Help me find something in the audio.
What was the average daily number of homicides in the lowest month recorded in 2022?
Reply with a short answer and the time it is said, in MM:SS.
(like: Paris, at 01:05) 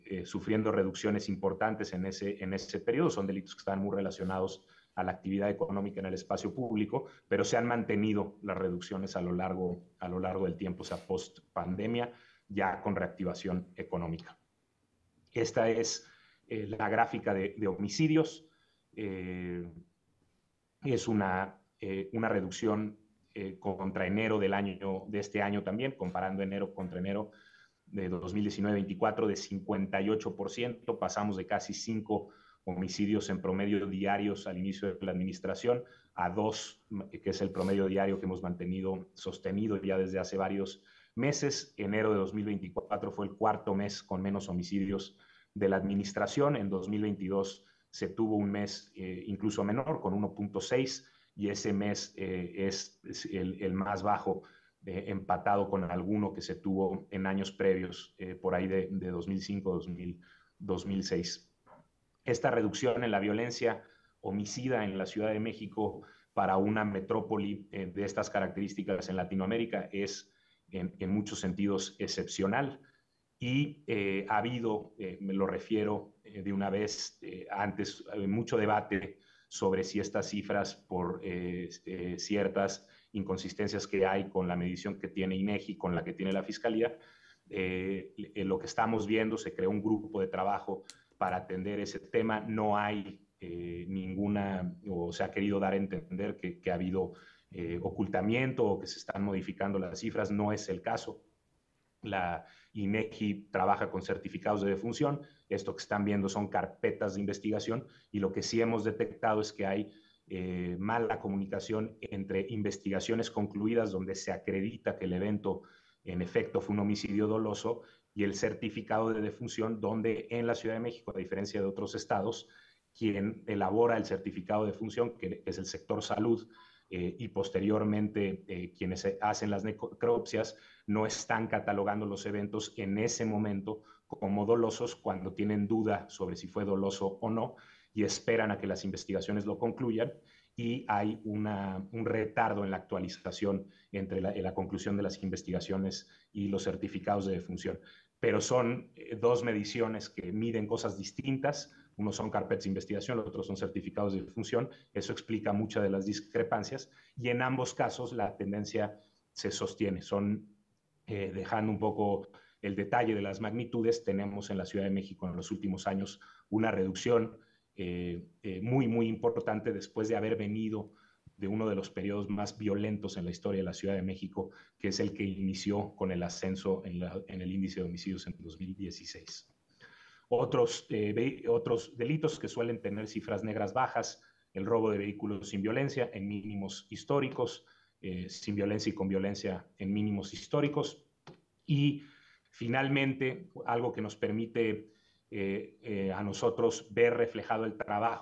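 1.6, at 00:50.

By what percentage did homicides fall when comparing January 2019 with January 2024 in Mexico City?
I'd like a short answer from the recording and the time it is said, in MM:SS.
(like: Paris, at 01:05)
58%, at 00:29.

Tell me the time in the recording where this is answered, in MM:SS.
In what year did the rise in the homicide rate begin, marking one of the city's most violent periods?
02:58.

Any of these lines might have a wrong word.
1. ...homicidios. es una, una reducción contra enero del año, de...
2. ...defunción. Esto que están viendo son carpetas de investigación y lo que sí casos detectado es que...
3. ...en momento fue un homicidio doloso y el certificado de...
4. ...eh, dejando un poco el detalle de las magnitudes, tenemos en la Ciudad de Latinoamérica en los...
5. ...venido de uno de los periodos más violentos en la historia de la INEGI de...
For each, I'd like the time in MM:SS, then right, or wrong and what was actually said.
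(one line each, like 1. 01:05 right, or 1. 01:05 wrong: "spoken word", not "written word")
1. 00:17 right
2. 01:44 wrong: "hemos", not "casos"
3. 01:56 wrong: "efecto", not "momento"
4. 02:41 wrong: "México", not "Latinoamérica"
5. 02:50 wrong: "Ciudad", not "INEGI".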